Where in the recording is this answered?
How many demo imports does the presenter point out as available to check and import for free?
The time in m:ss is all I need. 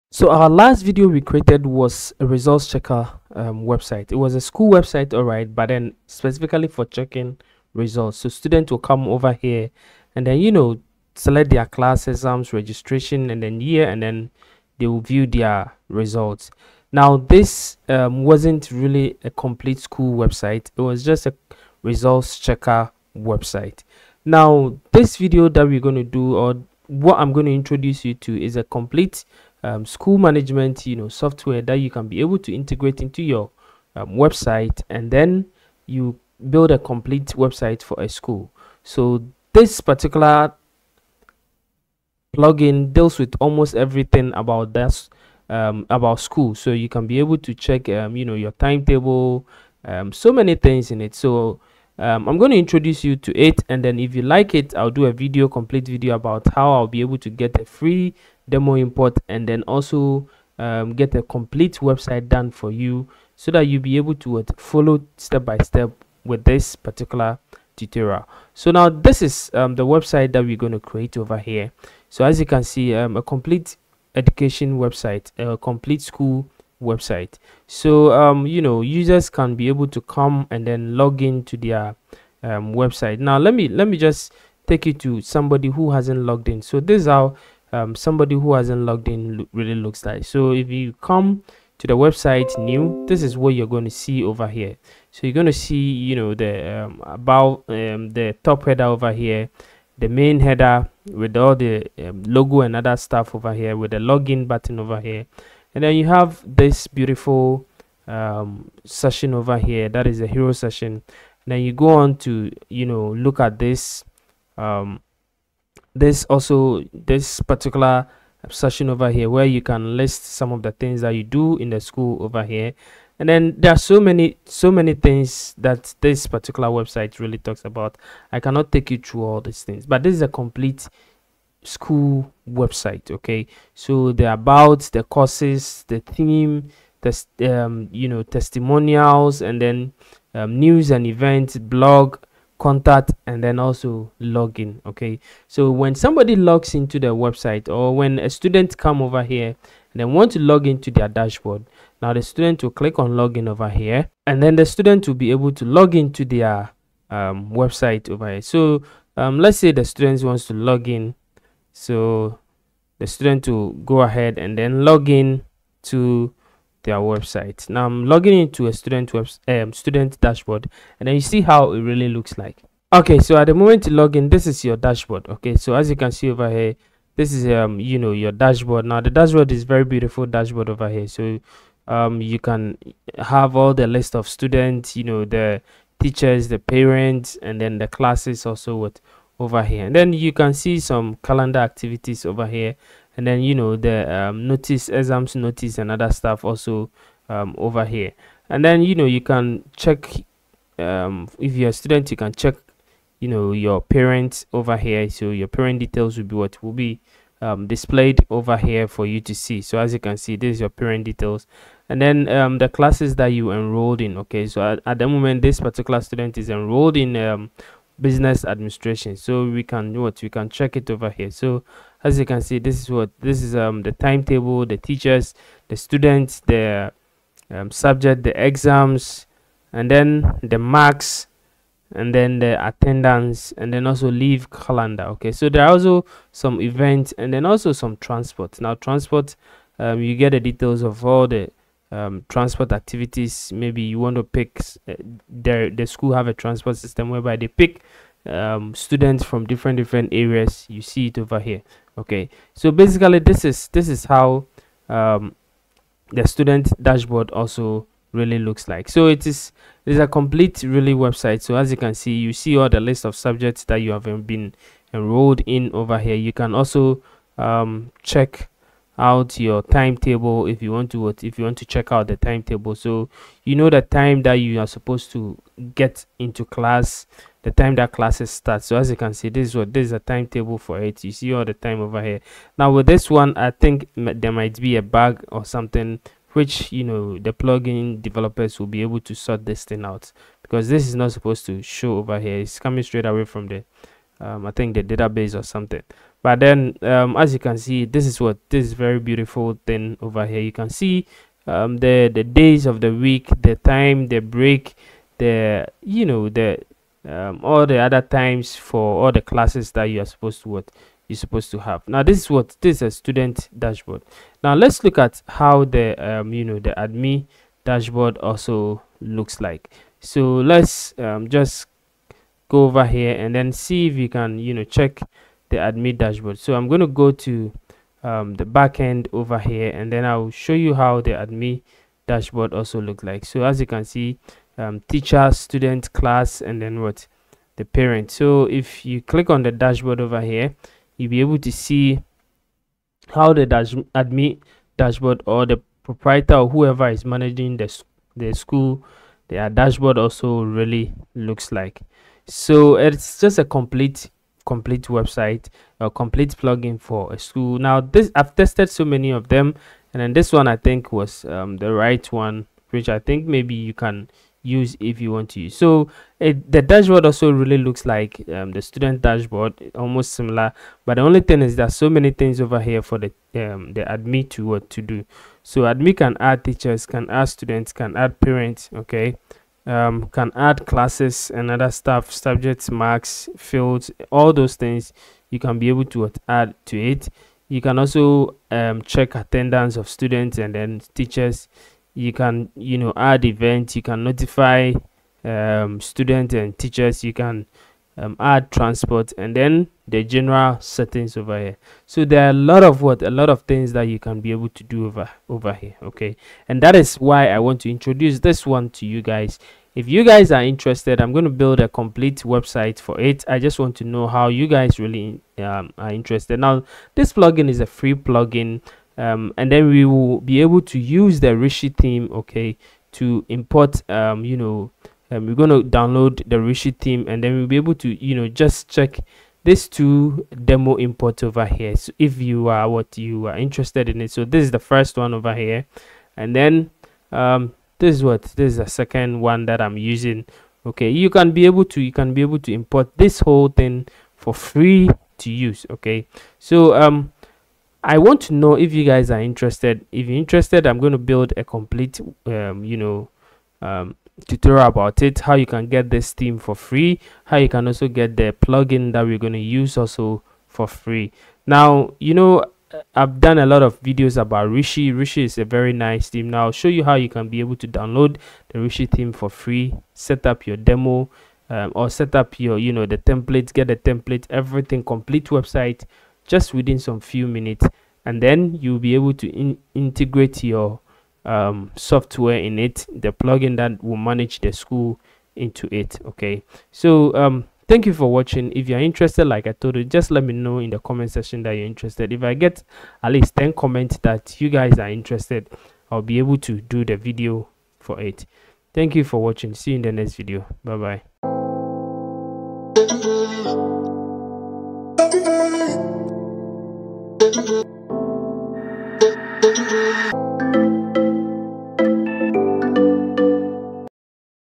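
7:09.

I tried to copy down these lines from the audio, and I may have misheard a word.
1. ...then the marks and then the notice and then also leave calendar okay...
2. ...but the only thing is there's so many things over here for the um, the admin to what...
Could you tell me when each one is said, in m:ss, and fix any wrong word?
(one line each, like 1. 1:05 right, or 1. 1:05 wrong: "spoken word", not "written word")
1. 3:49 wrong: "attendance", not "notice"
2. 6:10 right.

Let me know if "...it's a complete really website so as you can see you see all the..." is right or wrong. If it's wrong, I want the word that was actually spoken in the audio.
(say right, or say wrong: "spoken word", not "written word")
right.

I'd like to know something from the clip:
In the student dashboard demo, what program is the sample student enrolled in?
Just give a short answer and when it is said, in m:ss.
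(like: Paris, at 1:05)
Business administration, at 3:38.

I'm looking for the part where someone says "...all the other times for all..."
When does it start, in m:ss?
5:07.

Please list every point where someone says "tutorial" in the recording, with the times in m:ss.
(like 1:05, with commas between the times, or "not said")
1:07, 7:34.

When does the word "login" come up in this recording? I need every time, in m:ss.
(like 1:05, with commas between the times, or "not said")
1:43, 2:24, 2:33.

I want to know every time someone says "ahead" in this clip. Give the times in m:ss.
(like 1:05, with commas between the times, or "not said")
2:44.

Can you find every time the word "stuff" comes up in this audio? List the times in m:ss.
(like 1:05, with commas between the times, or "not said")
1:42, 3:16, 6:21.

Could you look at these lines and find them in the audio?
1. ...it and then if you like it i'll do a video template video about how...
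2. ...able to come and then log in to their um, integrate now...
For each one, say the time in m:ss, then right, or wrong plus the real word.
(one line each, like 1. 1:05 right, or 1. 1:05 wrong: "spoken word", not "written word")
1. 0:53 wrong: "complete", not "template"
2. 1:19 wrong: "website", not "integrate".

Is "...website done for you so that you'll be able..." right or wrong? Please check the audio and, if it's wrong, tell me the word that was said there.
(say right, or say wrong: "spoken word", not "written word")
right.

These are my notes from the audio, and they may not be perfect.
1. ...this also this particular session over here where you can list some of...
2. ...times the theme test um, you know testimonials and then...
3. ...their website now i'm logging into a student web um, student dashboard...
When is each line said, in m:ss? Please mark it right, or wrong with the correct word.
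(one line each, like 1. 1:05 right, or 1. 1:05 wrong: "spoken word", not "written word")
1. 1:55 right
2. 2:15 wrong: "courses", not "times"
3. 2:46 right.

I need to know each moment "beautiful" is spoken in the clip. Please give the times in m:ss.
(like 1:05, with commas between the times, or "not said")
1:46, 2:59, 4:58.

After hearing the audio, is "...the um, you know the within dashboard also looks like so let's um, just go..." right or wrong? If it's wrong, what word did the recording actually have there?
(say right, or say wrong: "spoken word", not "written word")
wrong: "admin", not "within".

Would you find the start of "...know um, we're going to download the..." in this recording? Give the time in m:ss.
7:04.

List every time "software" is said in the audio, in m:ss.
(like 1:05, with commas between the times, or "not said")
0:31, 8:01.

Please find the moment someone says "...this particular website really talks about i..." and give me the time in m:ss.
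2:06.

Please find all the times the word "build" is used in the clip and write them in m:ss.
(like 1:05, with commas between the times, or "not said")
0:36, 6:51, 7:30.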